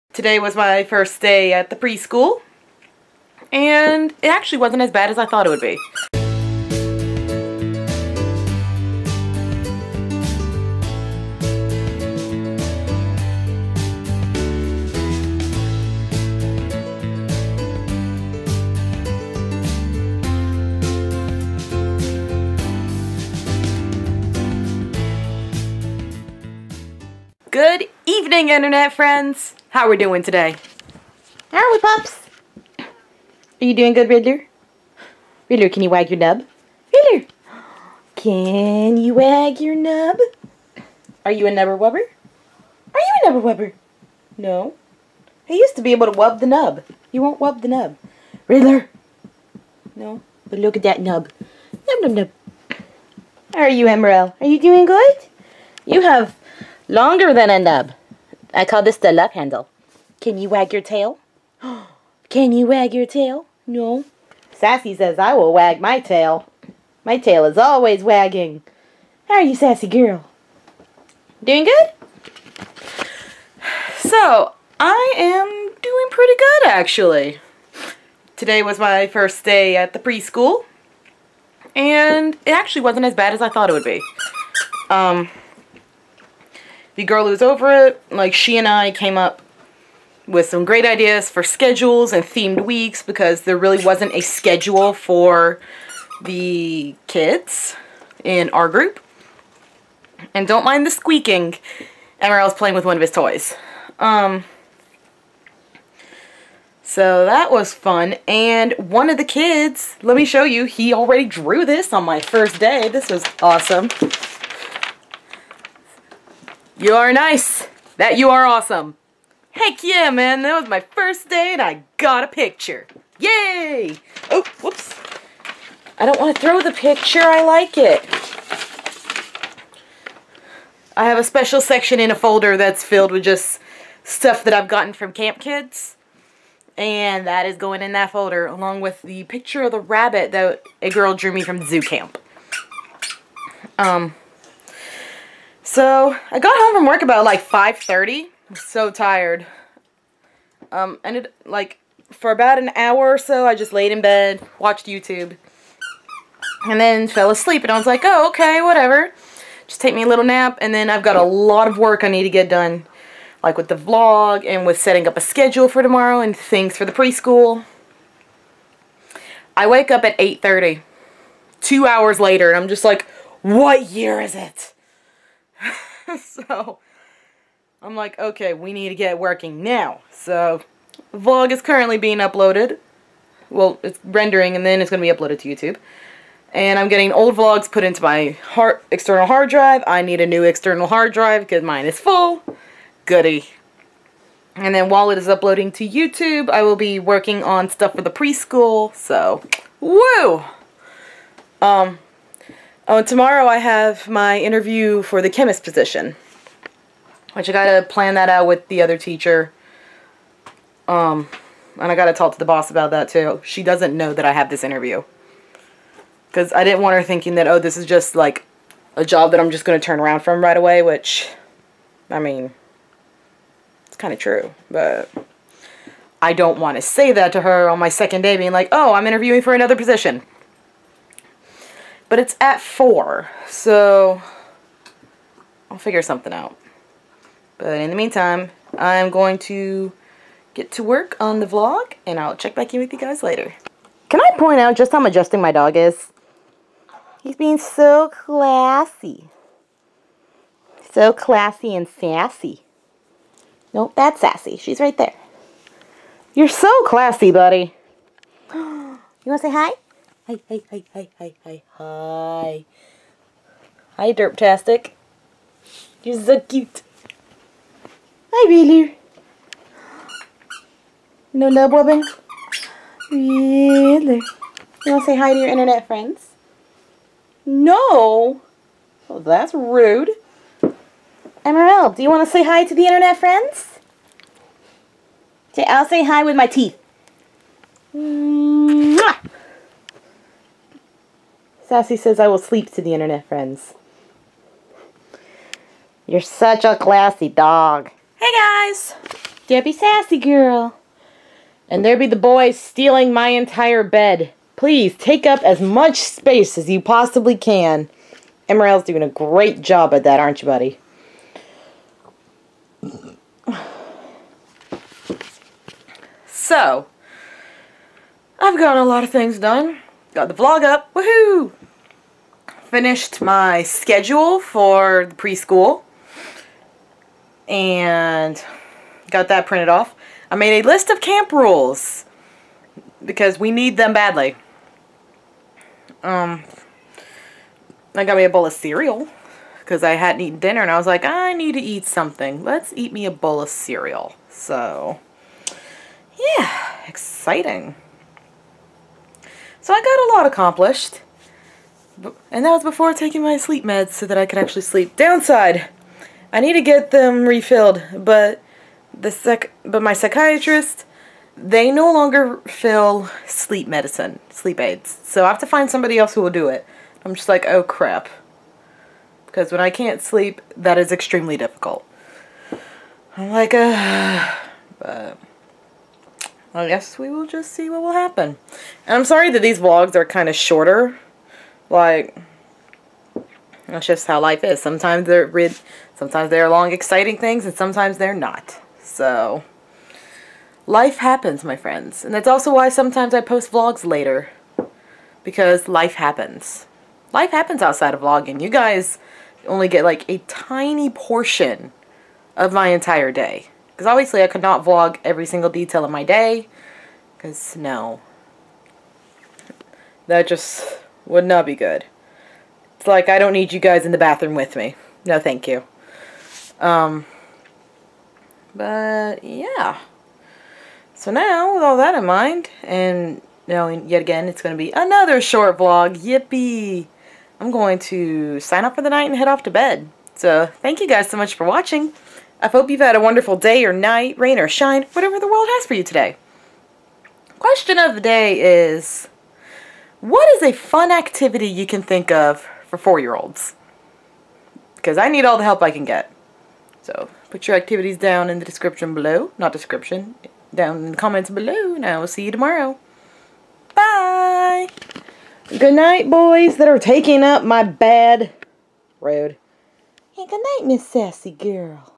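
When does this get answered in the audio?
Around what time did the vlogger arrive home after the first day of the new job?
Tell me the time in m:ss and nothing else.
2:27.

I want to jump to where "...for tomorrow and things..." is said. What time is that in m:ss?
2:45.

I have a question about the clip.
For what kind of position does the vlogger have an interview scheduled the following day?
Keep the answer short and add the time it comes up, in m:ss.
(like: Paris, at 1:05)
chemist, at 3:25.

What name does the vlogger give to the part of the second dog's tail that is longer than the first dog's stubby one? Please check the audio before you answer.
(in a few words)
love handle.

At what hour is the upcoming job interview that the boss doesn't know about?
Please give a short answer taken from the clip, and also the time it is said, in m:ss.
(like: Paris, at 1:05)
4, at 3:52.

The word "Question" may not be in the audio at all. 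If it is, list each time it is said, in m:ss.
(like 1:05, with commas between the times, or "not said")
7:17.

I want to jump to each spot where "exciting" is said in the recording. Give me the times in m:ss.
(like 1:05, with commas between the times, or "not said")
5:46, 6:26.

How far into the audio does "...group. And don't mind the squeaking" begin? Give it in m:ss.
1:38.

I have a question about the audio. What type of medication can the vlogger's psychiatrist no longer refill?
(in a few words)
sleep aids.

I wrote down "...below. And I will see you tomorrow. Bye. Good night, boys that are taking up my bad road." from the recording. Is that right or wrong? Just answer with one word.
right.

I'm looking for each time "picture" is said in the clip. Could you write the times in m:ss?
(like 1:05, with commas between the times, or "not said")
2:02, 2:06, 2:19.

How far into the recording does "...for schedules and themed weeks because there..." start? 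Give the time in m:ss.
1:31.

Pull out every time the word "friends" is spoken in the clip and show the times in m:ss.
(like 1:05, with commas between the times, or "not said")
0:28, 4:35, 4:43, 4:53, 6:31.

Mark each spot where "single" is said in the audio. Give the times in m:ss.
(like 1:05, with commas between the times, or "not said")
6:45.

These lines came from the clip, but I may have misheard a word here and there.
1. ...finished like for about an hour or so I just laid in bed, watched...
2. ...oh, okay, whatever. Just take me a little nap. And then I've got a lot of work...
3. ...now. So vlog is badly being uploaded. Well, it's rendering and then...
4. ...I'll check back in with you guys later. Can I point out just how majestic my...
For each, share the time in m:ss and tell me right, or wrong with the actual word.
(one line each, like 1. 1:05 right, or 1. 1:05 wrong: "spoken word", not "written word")
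1. 2:31 wrong: "ended", not "finished"
2. 2:38 right
3. 2:59 wrong: "currently", not "badly"
4. 4:02 right.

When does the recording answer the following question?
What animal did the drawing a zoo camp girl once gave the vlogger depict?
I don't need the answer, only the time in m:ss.
2:19.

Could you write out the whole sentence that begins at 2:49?
I wake up at 8.30, two hours later, and I'm just like, what year is it?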